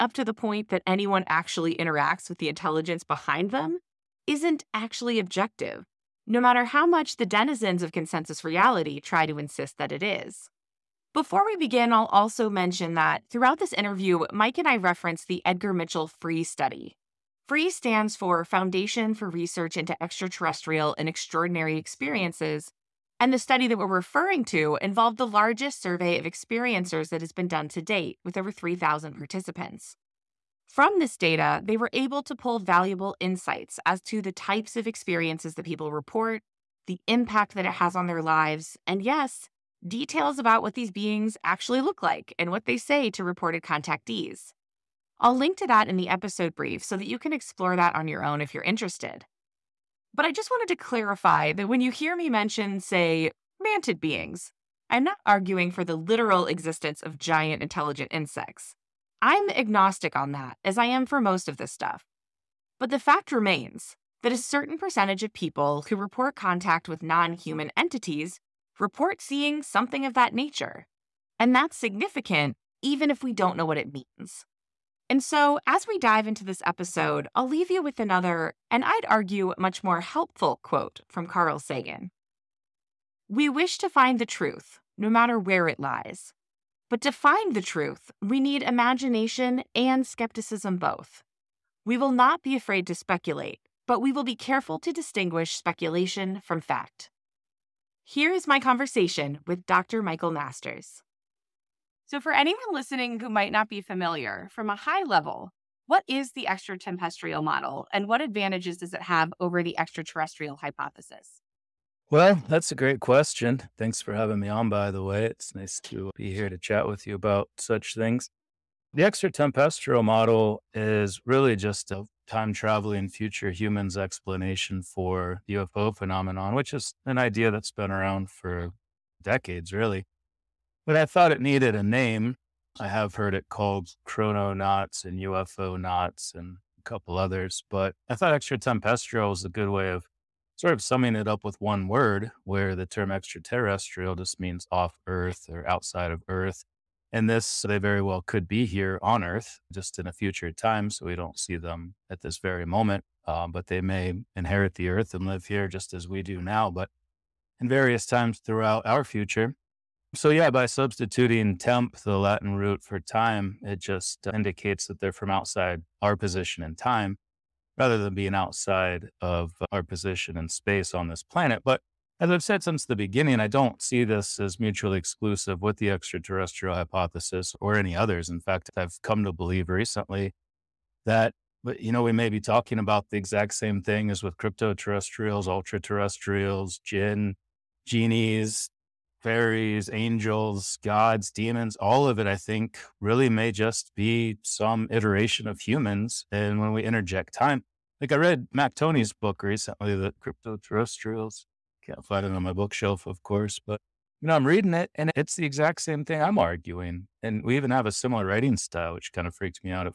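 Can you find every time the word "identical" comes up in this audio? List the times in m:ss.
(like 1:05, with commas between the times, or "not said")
not said.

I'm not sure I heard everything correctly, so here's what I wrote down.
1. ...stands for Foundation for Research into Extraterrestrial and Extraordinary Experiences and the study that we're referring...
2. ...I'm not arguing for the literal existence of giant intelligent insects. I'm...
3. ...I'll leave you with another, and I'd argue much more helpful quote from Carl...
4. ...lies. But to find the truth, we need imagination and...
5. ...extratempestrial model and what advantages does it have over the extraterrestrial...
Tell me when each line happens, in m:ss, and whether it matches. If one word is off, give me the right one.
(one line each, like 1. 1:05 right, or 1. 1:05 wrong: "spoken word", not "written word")
1. 0:17 right
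2. 0:54 right
3. 1:17 right
4. 1:25 right
5. 1:46 right.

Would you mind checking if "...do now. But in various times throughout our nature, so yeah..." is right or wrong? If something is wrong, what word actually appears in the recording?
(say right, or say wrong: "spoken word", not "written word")
wrong: "future", not "nature".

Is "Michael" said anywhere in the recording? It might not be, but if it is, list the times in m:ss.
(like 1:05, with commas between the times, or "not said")
1:40.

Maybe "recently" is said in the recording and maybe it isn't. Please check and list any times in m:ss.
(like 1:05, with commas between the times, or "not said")
2:59, 3:19.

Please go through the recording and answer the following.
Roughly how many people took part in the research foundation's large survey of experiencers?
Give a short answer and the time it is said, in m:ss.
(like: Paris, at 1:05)
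over 3,000, at 0:28.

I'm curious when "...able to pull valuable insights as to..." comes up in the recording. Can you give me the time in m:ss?
0:31.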